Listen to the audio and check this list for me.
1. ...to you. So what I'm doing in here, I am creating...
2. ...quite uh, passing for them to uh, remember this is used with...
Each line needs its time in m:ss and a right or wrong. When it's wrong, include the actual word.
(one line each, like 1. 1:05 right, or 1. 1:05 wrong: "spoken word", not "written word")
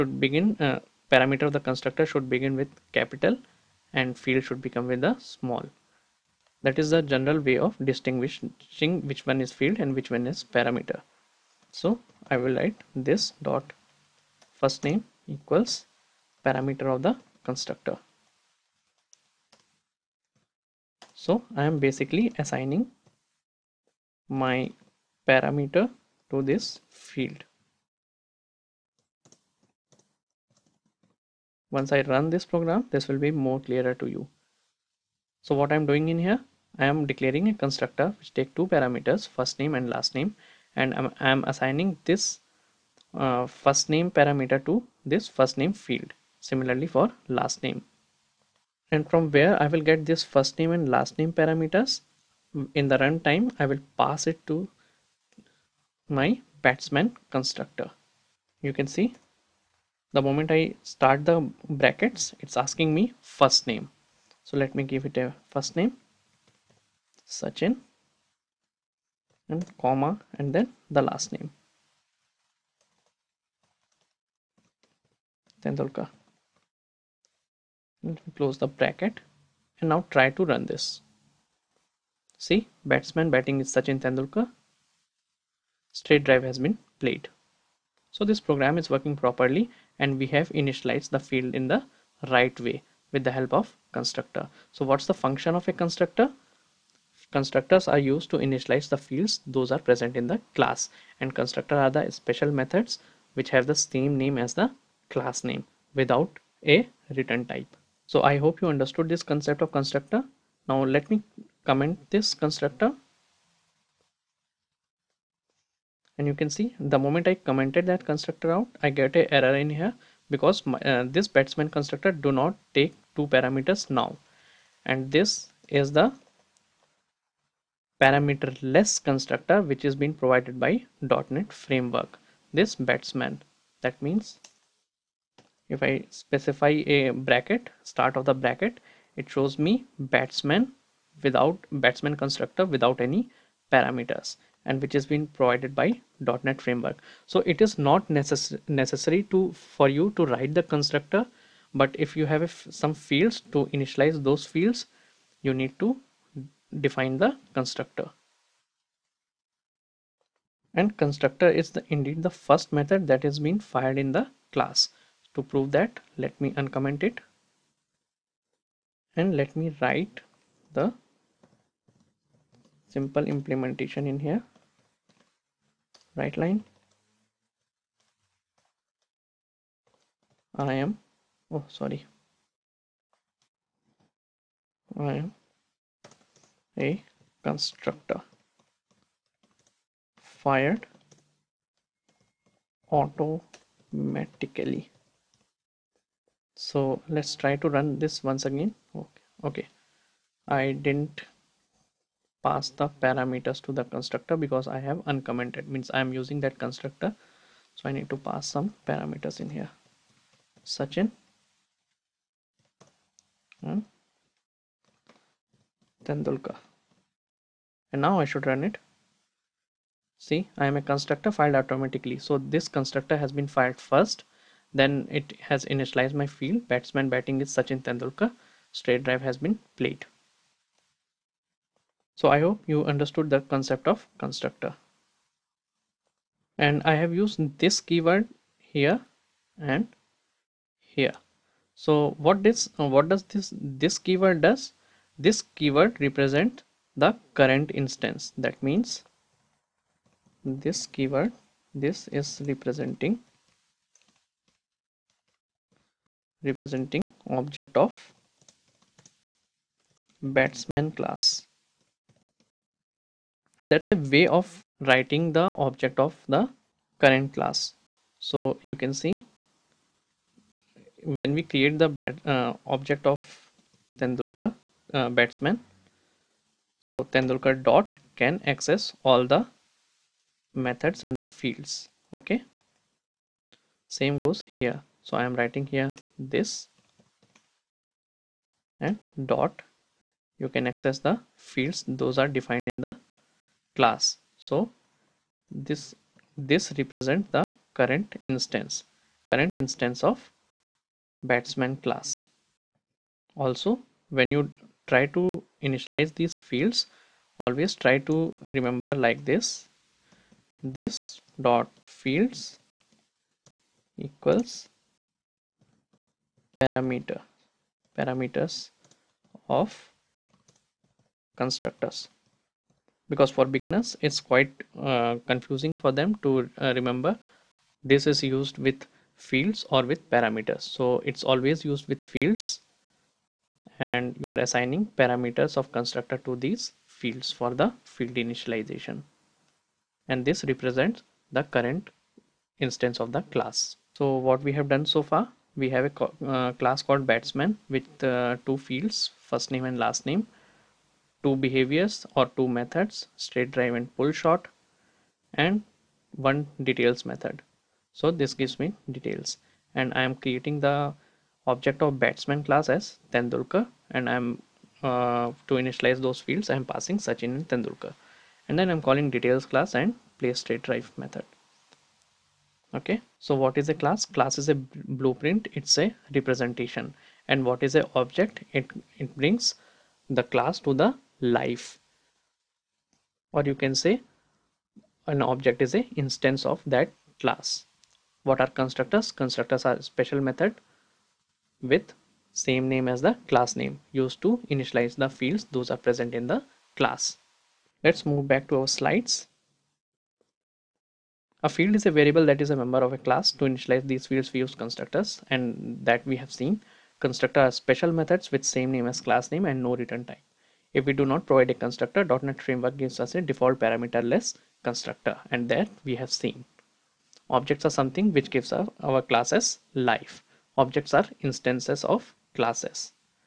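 1. 0:33 wrong: "declaring", not "creating"
2. 5:24 wrong: "confusing", not "passing".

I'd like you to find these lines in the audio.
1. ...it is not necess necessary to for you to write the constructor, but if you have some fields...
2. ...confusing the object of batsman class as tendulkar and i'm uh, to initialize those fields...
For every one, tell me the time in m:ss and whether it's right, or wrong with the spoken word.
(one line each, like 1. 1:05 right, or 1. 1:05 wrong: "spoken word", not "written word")
1. 2:27 right
2. 6:00 wrong: "creating", not "confusing".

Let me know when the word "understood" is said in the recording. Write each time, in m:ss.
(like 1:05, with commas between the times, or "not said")
1:48, 3:52.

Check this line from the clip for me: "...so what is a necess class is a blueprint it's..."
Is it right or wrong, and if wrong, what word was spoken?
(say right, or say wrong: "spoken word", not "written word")
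wrong: "class", not "necess".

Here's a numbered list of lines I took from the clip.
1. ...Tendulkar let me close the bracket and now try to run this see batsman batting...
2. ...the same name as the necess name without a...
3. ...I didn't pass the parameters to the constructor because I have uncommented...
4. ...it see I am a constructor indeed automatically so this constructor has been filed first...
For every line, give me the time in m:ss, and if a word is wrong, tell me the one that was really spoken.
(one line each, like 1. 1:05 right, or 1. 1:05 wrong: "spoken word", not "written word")
1. 1:15 right
2. 1:43 wrong: "class", not "necess"
3. 3:20 right
4. 3:38 wrong: "filed", not "indeed".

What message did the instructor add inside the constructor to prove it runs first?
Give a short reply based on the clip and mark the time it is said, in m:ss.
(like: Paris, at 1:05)
I am a constructor fired automatically, at 3:05.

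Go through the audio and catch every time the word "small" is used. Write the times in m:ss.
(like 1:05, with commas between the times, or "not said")
0:05.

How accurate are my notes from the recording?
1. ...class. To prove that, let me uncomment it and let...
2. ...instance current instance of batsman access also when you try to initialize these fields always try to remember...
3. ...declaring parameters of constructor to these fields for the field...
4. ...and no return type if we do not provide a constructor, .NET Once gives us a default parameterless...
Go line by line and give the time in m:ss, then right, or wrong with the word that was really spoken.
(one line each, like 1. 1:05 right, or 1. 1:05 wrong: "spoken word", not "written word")
1. 2:44 right
2. 4:58 wrong: "class", not "access"
3. 5:34 wrong: "assigning", not "declaring"
4. 6:49 wrong: "Framework", not "Once".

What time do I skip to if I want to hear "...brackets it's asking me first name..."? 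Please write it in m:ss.
1:01.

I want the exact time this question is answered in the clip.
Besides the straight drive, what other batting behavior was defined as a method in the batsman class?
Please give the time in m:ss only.
5:53.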